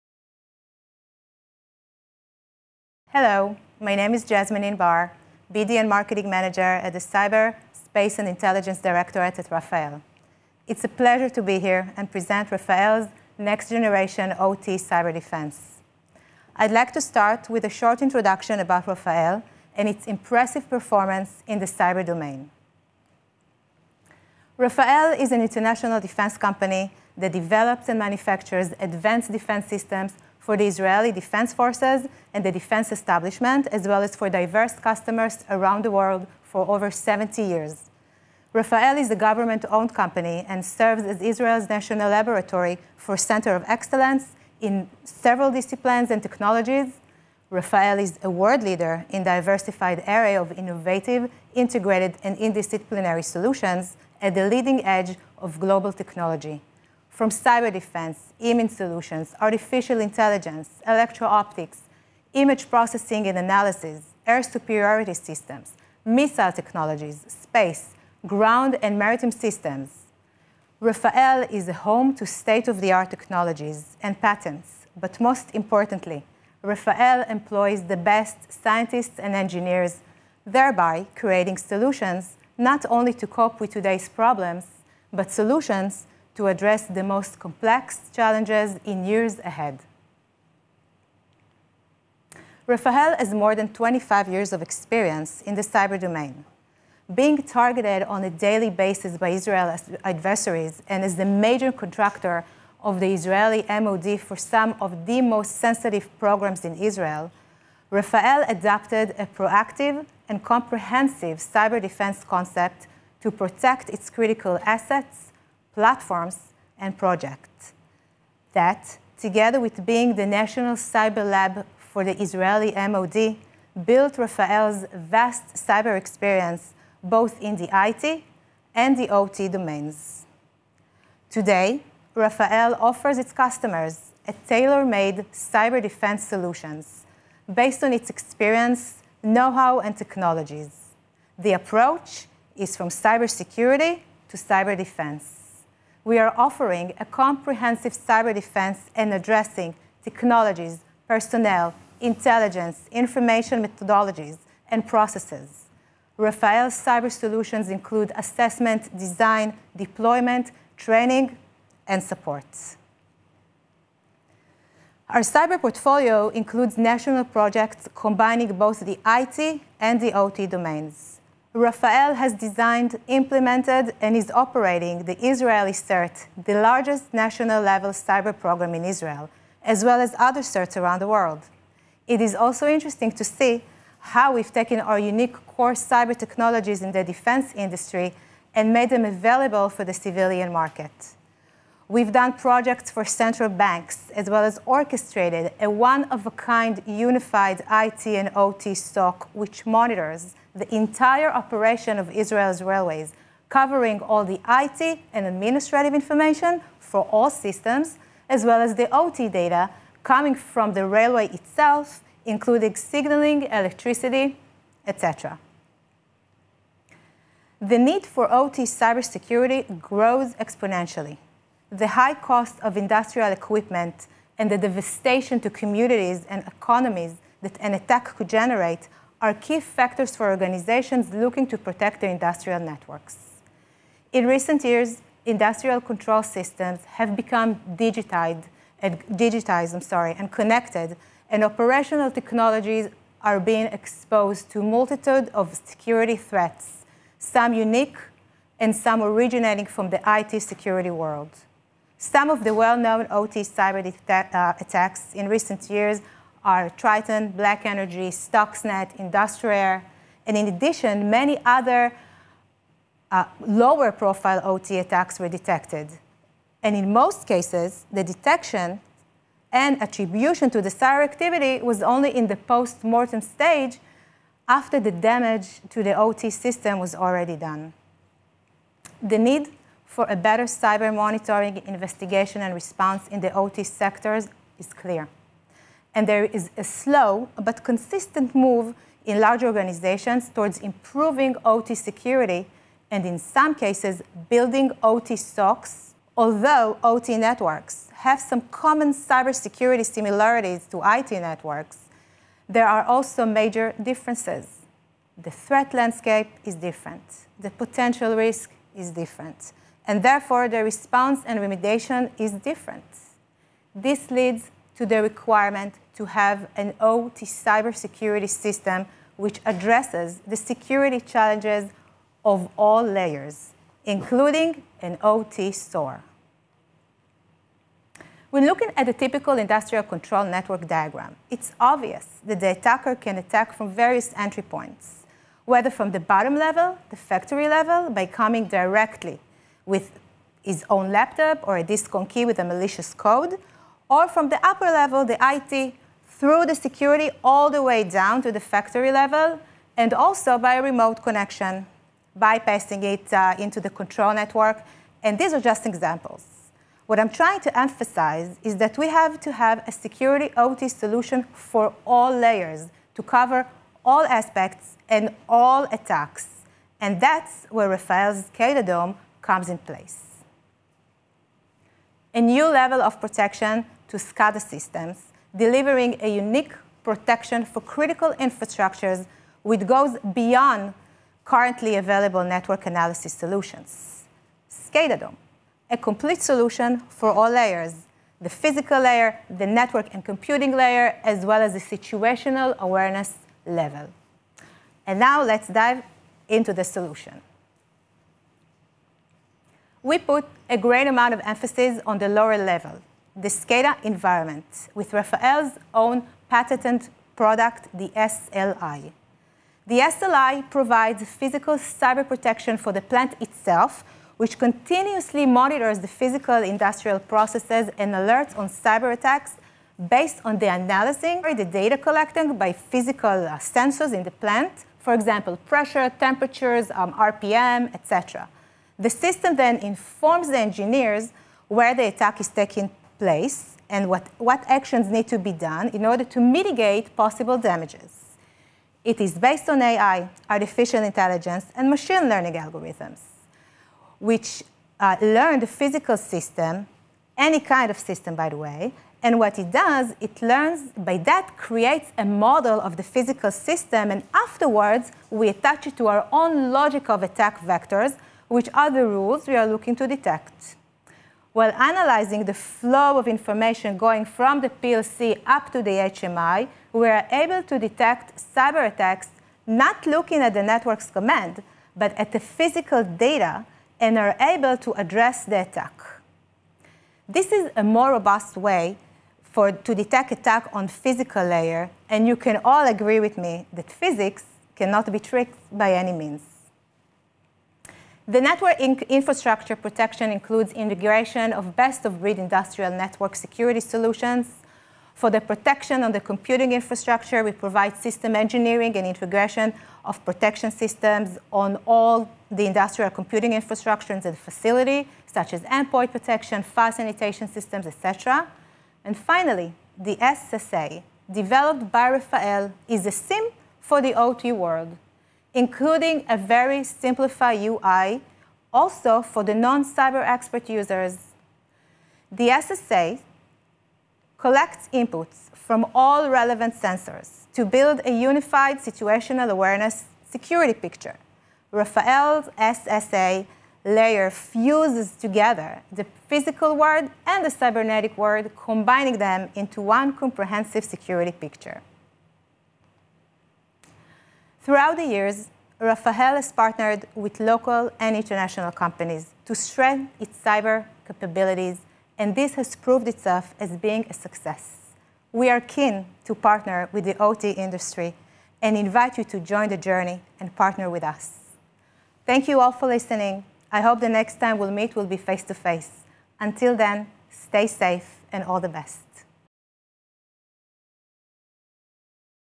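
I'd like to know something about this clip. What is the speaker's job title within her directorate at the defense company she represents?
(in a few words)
BD and Marketing Manager.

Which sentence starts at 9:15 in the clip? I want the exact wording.
We are keen to partner with the OT industry and invite you to join the journey and partner with us.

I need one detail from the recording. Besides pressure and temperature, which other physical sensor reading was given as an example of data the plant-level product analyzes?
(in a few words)
RPM.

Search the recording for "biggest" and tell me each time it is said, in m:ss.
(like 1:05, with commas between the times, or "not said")
not said.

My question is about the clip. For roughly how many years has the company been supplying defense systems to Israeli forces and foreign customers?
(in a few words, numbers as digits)
Over 70 years.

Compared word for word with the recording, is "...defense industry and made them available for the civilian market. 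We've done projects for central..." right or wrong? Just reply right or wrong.
right.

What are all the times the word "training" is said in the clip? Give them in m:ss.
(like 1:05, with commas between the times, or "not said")
2:40.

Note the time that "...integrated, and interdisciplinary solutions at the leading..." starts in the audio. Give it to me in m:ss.
0:51.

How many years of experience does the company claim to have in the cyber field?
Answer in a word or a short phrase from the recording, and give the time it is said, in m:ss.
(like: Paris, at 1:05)
More than 25, at 1:33.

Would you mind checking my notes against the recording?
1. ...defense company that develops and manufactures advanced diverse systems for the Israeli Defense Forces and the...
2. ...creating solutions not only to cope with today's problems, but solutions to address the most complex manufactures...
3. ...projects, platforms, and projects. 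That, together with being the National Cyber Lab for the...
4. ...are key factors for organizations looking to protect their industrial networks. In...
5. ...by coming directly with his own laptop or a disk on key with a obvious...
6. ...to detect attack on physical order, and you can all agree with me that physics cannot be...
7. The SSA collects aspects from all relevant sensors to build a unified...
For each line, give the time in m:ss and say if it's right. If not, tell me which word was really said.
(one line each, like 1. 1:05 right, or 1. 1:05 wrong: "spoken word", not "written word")
1. 0:25 wrong: "defense", not "diverse"
2. 1:21 wrong: "challenges", not "manufactures"
3. 1:54 wrong: "assets", not "projects"
4. 3:49 right
5. 5:37 wrong: "malicious", not "obvious"
6. 7:59 wrong: "layer", not "order"
7. 8:42 wrong: "inputs", not "aspects".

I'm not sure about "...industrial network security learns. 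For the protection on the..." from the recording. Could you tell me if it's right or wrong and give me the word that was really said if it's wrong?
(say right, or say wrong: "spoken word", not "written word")
wrong: "solutions", not "learns".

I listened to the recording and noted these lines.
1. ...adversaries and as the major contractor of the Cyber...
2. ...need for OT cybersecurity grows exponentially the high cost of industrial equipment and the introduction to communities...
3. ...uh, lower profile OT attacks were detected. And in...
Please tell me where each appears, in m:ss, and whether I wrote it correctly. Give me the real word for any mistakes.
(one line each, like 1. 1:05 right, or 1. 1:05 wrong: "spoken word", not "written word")
1. 1:40 wrong: "Israeli", not "Cyber"
2. 3:37 wrong: "devastation", not "introduction"
3. 4:23 right.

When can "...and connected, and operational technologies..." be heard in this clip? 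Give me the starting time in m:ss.
4:00.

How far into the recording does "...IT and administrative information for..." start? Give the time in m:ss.
3:24.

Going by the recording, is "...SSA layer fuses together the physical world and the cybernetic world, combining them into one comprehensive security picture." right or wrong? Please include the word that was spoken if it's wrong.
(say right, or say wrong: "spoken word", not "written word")
right.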